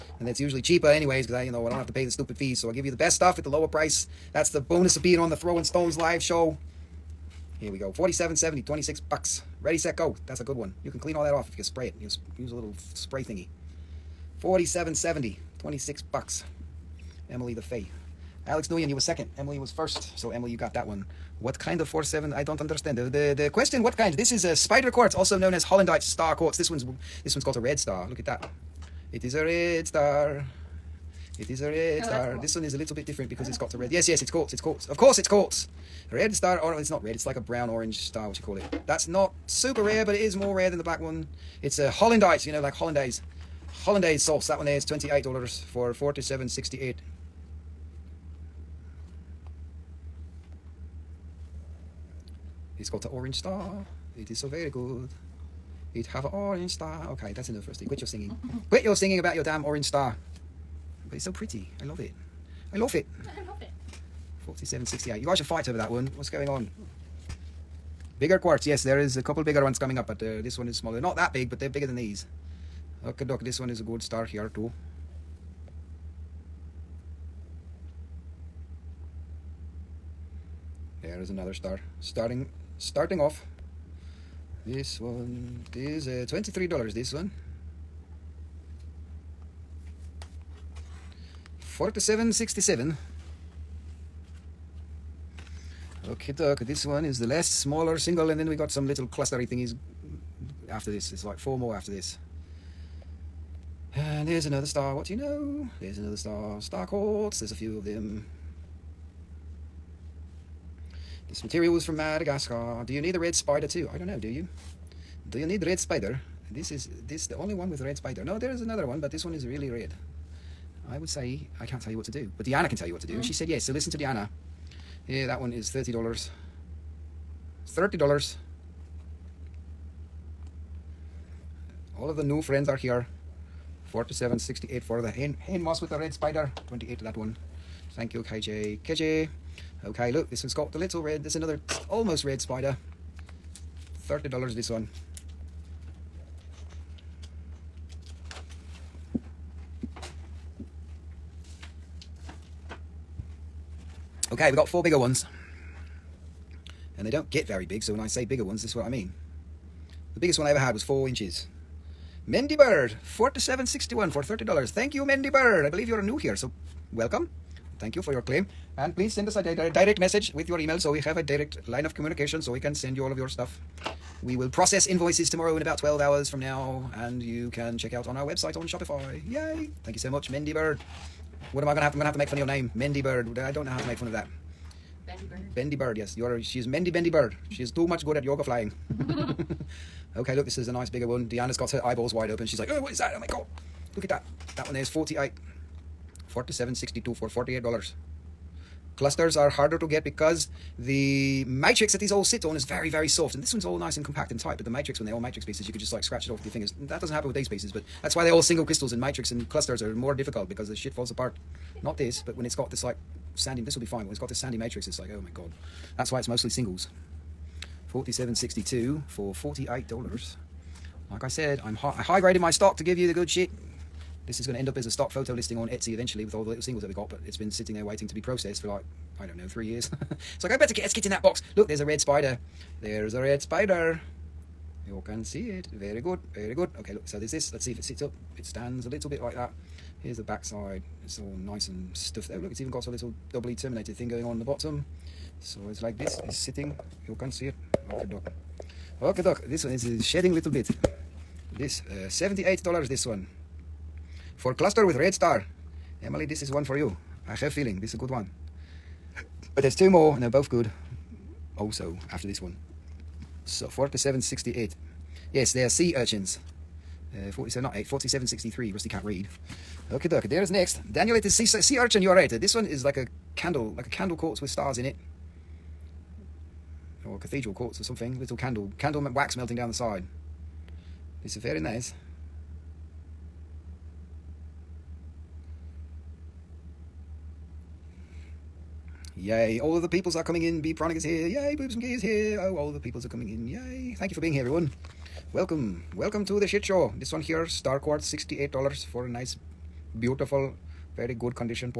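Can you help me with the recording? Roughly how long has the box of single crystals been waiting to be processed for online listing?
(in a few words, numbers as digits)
3 years.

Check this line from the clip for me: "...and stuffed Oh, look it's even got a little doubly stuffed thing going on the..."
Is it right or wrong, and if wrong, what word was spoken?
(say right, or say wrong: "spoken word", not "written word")
wrong: "terminated", not "stuffed".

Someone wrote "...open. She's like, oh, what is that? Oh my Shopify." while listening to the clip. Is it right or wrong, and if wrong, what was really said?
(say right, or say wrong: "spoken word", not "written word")
wrong: "God", not "Shopify".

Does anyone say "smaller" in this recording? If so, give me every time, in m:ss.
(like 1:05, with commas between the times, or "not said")
1:10, 1:37.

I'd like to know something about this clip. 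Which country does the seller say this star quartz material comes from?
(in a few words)
Madagascar.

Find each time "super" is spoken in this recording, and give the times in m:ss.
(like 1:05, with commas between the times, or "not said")
0:39.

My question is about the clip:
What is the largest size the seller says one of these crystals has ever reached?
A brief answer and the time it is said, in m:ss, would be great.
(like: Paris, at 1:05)
4 inches, at 2:40.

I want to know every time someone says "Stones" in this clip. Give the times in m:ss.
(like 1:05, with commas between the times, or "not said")
0:05.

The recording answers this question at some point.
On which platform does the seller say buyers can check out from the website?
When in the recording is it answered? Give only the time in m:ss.
2:58.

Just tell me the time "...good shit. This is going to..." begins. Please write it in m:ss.
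3:43.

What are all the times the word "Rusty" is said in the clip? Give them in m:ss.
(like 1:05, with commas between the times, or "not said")
0:57, 4:28.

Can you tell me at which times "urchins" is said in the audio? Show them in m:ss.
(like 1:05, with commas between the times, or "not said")
4:25, 4:31.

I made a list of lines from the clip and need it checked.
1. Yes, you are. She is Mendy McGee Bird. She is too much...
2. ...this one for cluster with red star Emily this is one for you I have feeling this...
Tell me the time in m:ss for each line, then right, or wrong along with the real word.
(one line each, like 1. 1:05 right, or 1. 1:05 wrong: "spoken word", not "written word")
1. 3:05 wrong: "Bendy", not "McGee"
2. 4:12 right.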